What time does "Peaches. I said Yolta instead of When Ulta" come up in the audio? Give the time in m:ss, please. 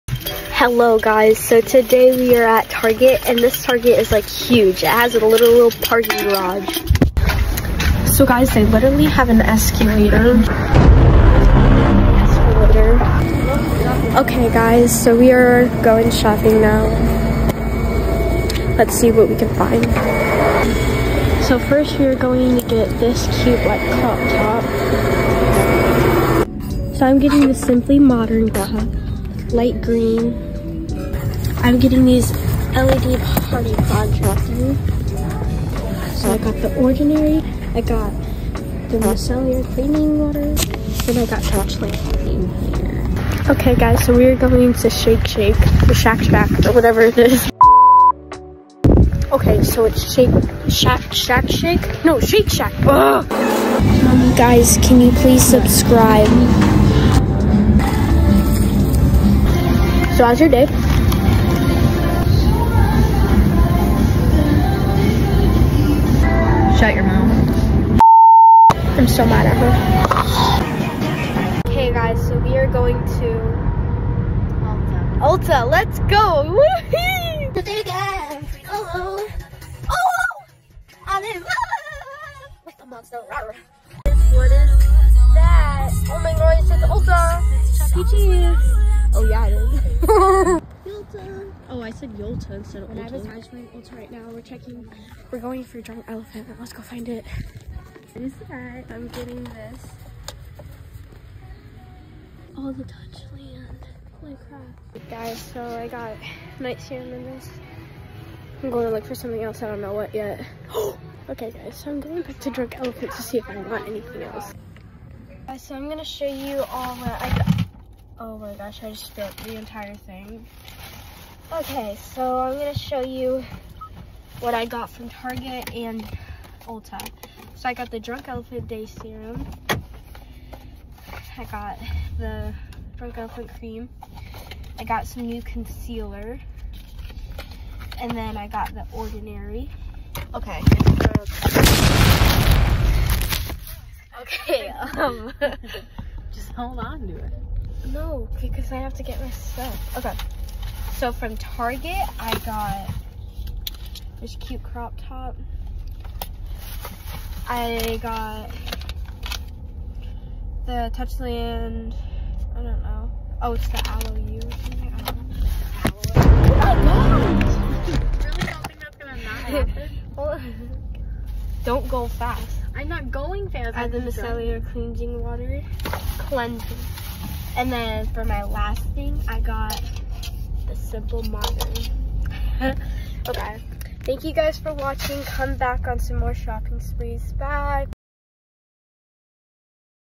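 1:27.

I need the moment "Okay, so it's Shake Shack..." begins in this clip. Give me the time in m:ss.
0:49.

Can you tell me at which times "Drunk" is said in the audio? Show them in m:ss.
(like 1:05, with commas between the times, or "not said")
1:52, 2:07, 2:12.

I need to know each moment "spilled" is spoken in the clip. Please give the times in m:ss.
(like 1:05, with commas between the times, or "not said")
1:59.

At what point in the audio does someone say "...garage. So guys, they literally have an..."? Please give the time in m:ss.
0:06.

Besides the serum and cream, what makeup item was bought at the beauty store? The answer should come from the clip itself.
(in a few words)
Concealer.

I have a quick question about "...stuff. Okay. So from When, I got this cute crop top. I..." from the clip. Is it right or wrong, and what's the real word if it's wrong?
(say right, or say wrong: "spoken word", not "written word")
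wrong: "Target", not "When".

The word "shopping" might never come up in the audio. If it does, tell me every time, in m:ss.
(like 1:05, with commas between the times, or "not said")
0:16, 3:06.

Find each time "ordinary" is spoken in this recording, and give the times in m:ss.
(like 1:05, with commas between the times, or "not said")
0:36, 2:18.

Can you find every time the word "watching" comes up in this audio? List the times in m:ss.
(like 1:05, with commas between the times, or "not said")
3:04.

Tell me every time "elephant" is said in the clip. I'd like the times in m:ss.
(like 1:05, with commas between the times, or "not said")
1:36, 1:52, 2:08, 2:13.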